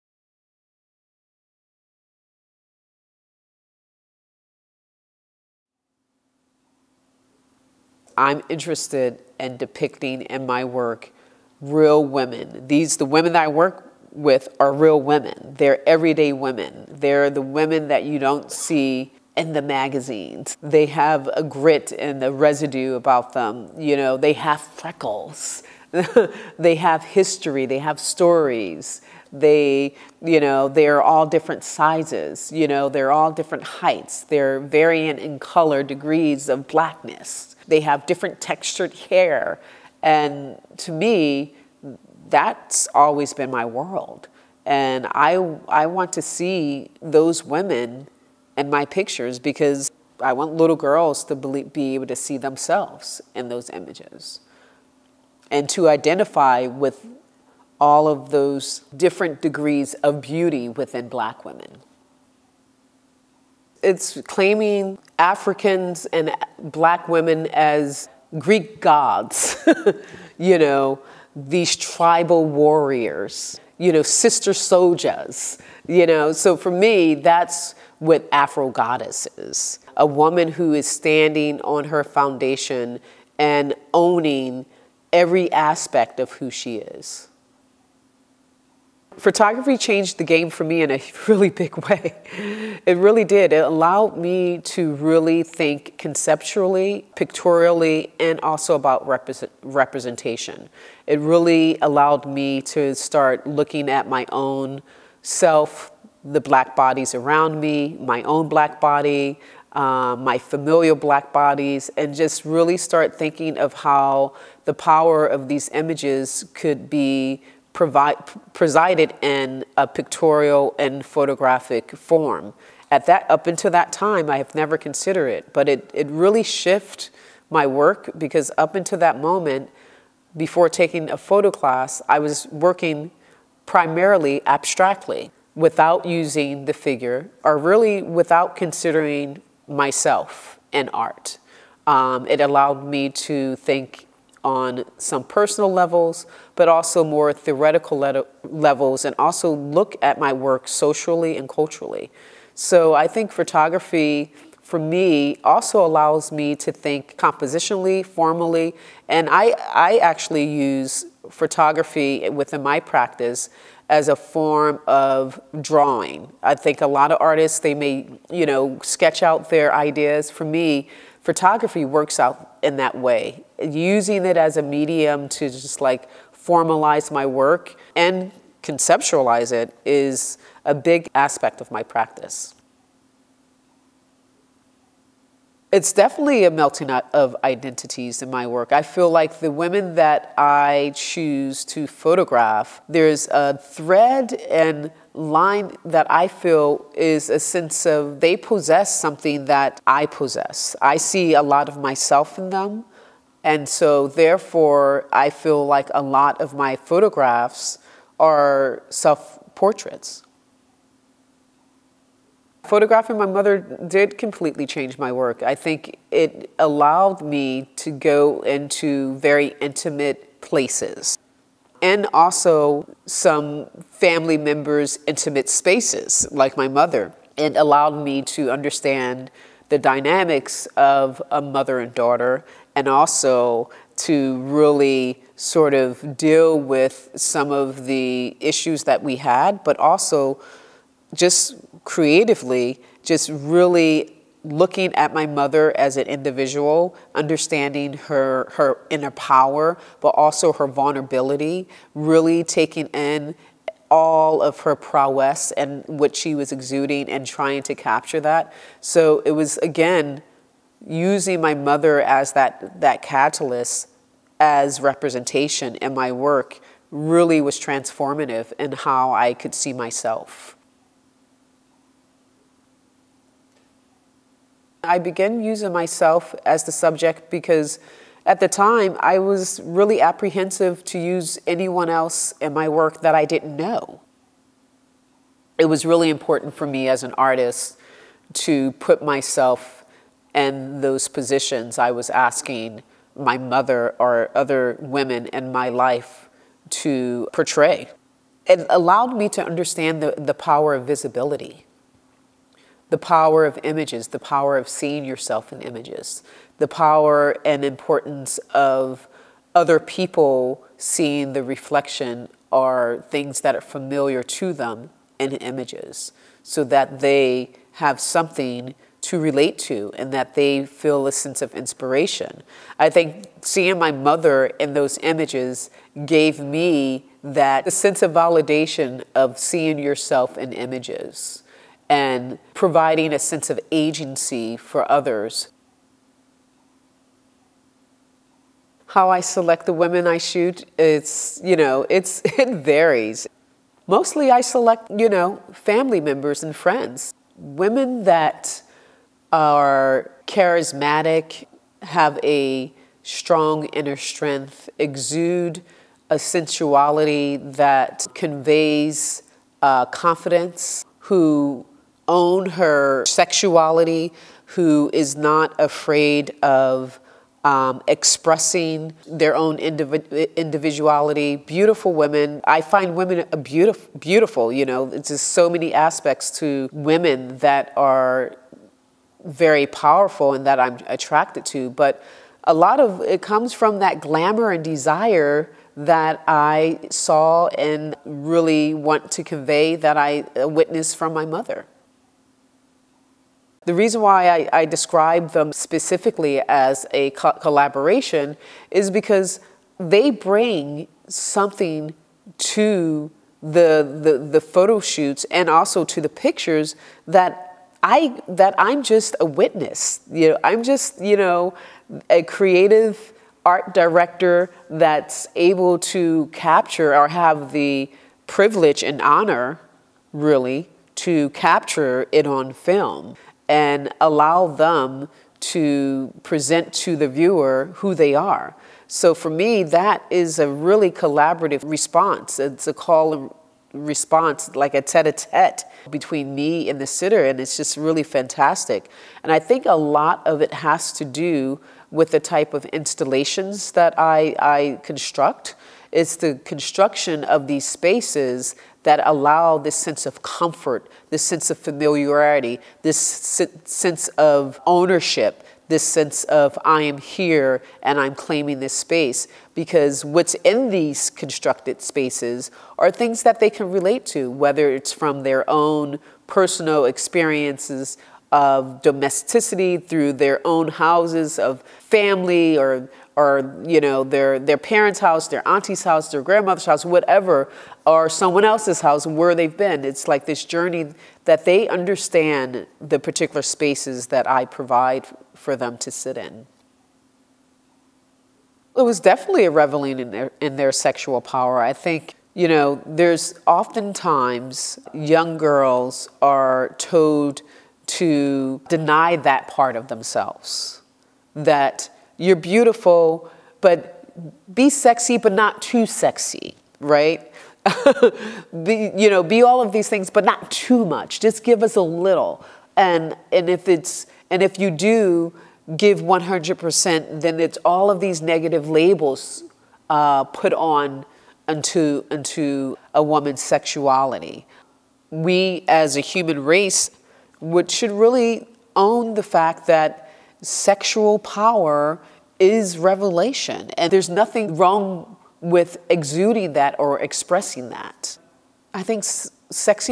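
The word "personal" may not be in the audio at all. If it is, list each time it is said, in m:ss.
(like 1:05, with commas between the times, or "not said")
2:25, 7:46.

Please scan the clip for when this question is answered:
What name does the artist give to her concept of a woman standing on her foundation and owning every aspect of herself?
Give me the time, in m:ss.
1:18.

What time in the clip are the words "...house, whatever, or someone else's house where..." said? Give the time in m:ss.
7:56.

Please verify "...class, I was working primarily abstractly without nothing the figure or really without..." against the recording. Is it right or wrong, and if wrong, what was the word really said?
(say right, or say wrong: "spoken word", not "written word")
wrong: "using", not "nothing".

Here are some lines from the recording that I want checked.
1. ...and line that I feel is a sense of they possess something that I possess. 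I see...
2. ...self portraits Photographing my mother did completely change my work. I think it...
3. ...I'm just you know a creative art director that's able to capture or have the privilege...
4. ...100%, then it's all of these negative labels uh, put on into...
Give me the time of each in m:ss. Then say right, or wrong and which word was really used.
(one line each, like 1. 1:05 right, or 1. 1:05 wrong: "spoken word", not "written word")
1. 3:14 right
2. 3:28 right
3. 6:50 right
4. 8:36 right.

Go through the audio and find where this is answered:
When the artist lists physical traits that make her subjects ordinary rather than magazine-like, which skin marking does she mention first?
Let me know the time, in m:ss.
0:24.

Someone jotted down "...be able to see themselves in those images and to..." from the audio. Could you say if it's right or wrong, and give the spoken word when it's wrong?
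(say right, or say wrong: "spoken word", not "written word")
right.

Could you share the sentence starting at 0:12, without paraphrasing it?
These, the women that I work with are real women.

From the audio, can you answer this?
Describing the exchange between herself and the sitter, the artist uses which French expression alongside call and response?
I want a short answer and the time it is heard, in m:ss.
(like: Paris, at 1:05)
Tete a tete, at 7:14.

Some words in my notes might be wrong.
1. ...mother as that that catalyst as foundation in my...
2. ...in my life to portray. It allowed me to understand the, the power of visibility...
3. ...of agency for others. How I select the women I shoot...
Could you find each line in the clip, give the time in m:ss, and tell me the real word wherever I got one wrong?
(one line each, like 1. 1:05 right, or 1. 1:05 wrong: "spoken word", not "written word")
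1. 4:21 wrong: "representation", not "foundation"
2. 4:55 right
3. 5:33 right.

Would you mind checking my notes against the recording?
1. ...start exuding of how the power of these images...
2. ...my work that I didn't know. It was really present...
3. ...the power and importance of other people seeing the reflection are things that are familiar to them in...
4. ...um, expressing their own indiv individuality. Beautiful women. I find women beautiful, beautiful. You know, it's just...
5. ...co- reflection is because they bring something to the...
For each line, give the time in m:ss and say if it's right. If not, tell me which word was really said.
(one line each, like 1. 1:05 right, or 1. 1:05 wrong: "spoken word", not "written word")
1. 1:52 wrong: "thinking", not "exuding"
2. 4:42 wrong: "important", not "present"
3. 5:06 right
4. 6:07 right
5. 6:37 wrong: "collaboration", not "reflection".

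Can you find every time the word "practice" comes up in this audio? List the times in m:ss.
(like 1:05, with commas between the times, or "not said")
2:42, 3:01.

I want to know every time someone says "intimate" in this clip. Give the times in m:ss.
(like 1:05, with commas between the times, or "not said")
3:39, 3:45.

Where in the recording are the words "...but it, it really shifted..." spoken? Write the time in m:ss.
2:05.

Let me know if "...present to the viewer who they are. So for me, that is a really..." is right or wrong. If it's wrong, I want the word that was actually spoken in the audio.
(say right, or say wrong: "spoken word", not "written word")
right.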